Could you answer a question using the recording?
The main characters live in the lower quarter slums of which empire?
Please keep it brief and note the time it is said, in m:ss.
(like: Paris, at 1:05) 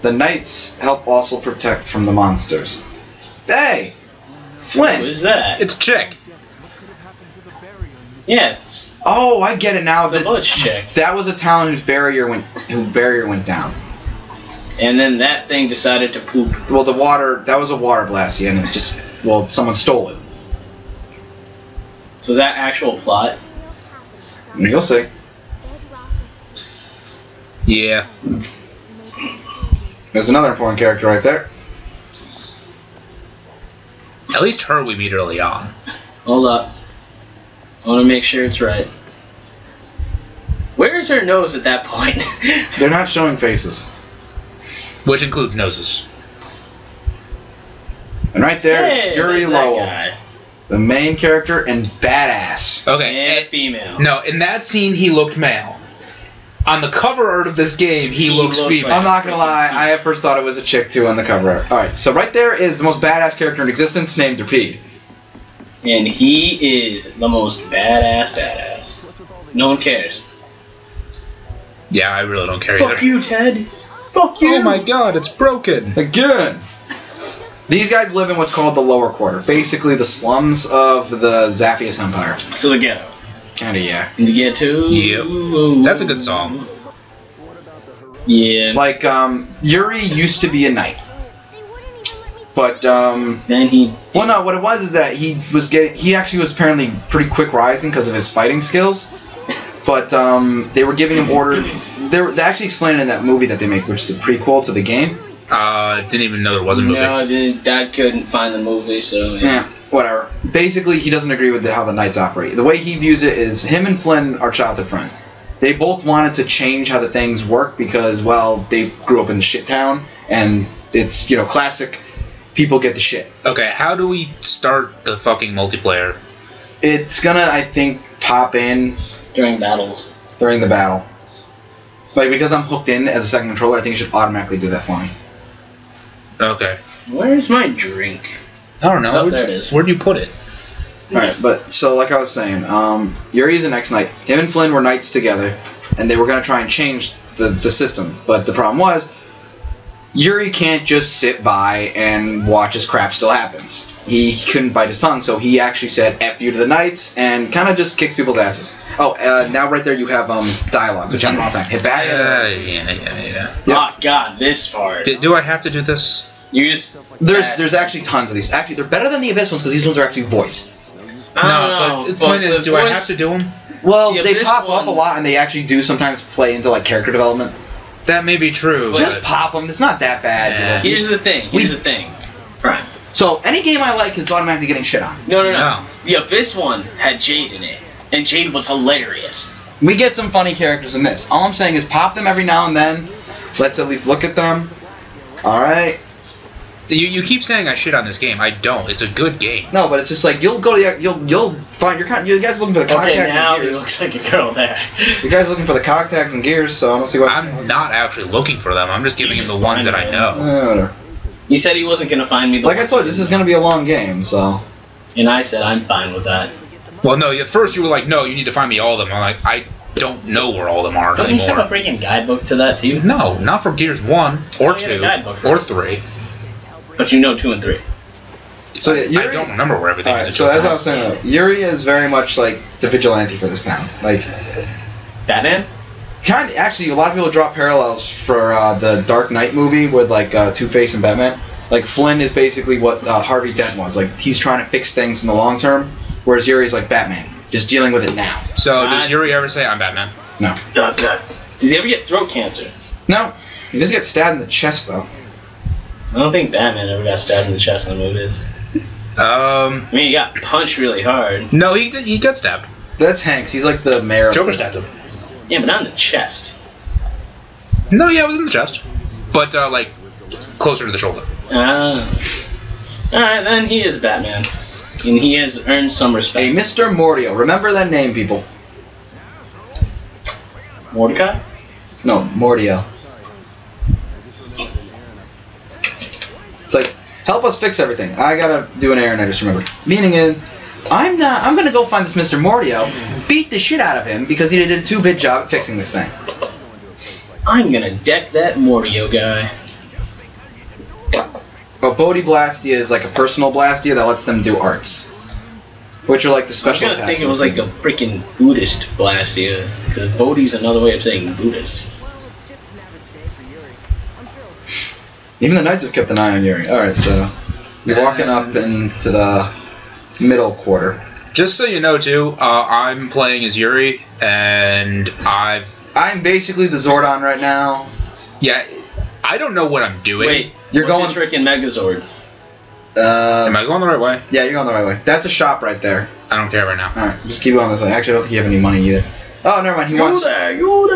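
Zaphias Empire, at 1:21.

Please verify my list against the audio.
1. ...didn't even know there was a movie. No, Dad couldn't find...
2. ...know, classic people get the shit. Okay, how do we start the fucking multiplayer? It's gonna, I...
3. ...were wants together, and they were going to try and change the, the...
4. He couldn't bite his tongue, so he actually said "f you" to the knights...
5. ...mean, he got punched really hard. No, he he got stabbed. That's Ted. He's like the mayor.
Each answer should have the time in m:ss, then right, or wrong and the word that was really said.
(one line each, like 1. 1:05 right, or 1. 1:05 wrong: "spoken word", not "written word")
1. 1:46 right
2. 2:01 right
3. 2:24 wrong: "knights", not "wants"
4. 2:34 right
5. 4:19 wrong: "Hanks", not "Ted".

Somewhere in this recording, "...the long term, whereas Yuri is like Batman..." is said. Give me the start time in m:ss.
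4:05.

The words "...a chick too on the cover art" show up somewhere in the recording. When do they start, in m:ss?
1:00.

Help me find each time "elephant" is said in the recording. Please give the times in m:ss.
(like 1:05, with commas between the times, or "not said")
not said.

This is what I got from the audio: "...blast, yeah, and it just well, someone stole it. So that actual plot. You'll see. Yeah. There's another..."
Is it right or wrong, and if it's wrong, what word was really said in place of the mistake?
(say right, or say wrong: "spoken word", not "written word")
right.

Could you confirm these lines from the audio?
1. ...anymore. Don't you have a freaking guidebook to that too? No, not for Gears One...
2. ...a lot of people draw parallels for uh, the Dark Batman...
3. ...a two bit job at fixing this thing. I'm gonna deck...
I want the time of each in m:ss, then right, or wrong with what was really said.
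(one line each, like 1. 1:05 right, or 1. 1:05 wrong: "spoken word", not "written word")
1. 3:41 right
2. 3:56 wrong: "Knight", not "Batman"
3. 4:54 right.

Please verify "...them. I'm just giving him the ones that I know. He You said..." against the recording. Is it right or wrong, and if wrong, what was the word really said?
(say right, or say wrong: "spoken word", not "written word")
right.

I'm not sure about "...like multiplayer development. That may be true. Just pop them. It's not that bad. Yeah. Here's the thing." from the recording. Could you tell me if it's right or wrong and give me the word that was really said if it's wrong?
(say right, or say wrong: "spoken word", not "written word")
wrong: "character", not "multiplayer".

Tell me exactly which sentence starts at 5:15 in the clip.
Even the knights have kept an eye on Yuri.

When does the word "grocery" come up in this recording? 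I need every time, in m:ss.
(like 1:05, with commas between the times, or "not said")
not said.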